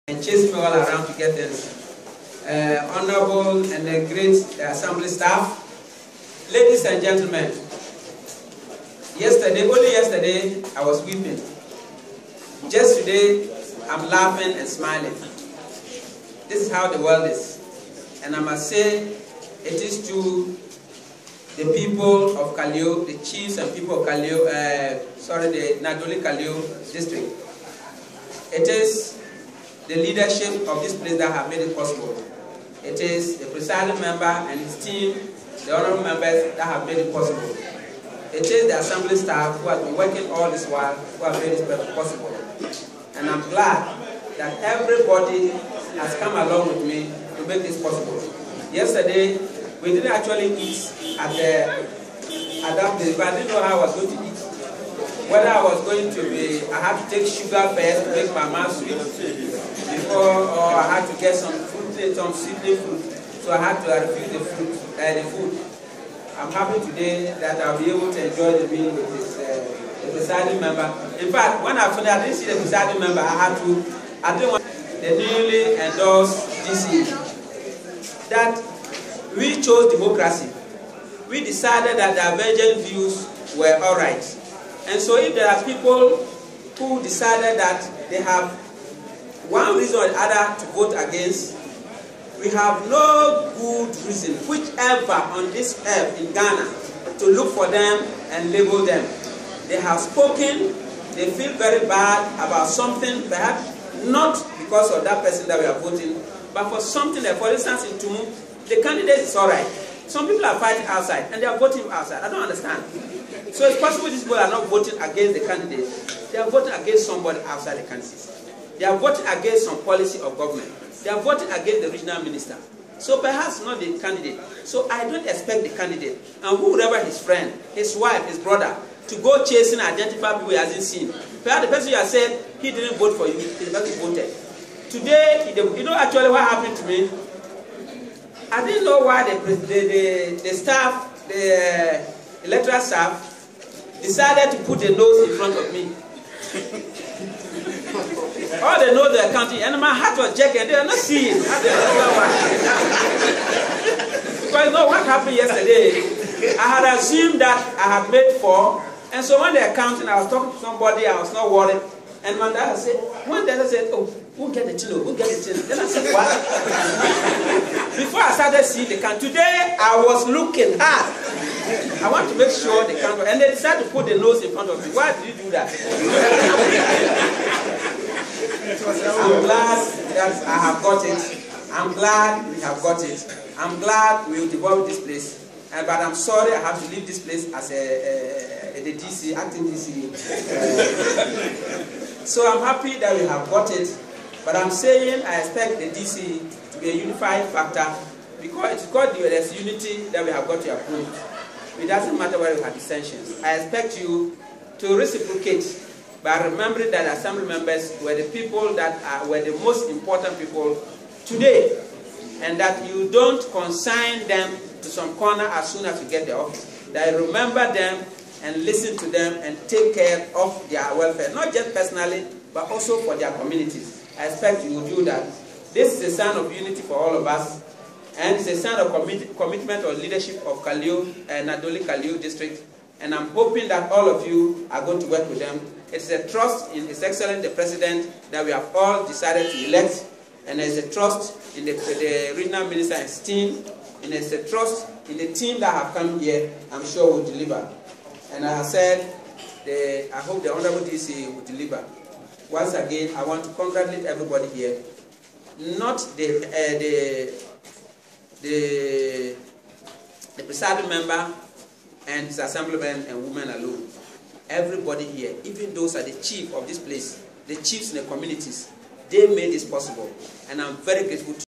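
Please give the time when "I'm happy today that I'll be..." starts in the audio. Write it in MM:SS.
01:06.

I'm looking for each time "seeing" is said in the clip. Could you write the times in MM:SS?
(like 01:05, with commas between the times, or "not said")
02:30, 02:48.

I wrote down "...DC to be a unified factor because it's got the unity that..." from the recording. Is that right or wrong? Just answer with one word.
right.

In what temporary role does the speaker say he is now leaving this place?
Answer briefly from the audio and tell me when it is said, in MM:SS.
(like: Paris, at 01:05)
Acting DC, at 03:09.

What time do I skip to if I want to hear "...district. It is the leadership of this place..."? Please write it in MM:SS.
00:26.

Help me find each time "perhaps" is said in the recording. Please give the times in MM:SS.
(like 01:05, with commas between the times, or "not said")
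01:43, 02:03, 02:11.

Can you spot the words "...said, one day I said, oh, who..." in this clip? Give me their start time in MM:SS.
02:42.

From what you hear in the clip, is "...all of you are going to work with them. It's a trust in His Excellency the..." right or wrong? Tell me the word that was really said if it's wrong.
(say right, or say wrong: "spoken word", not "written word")
right.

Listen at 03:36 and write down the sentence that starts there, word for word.
That you remember them and listen to them and take care of their welfare, not just personally, but also for their communities.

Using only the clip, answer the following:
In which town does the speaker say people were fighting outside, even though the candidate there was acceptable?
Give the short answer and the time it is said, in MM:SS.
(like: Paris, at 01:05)
Tumu, at 01:47.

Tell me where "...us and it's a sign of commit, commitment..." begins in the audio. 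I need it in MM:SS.
03:47.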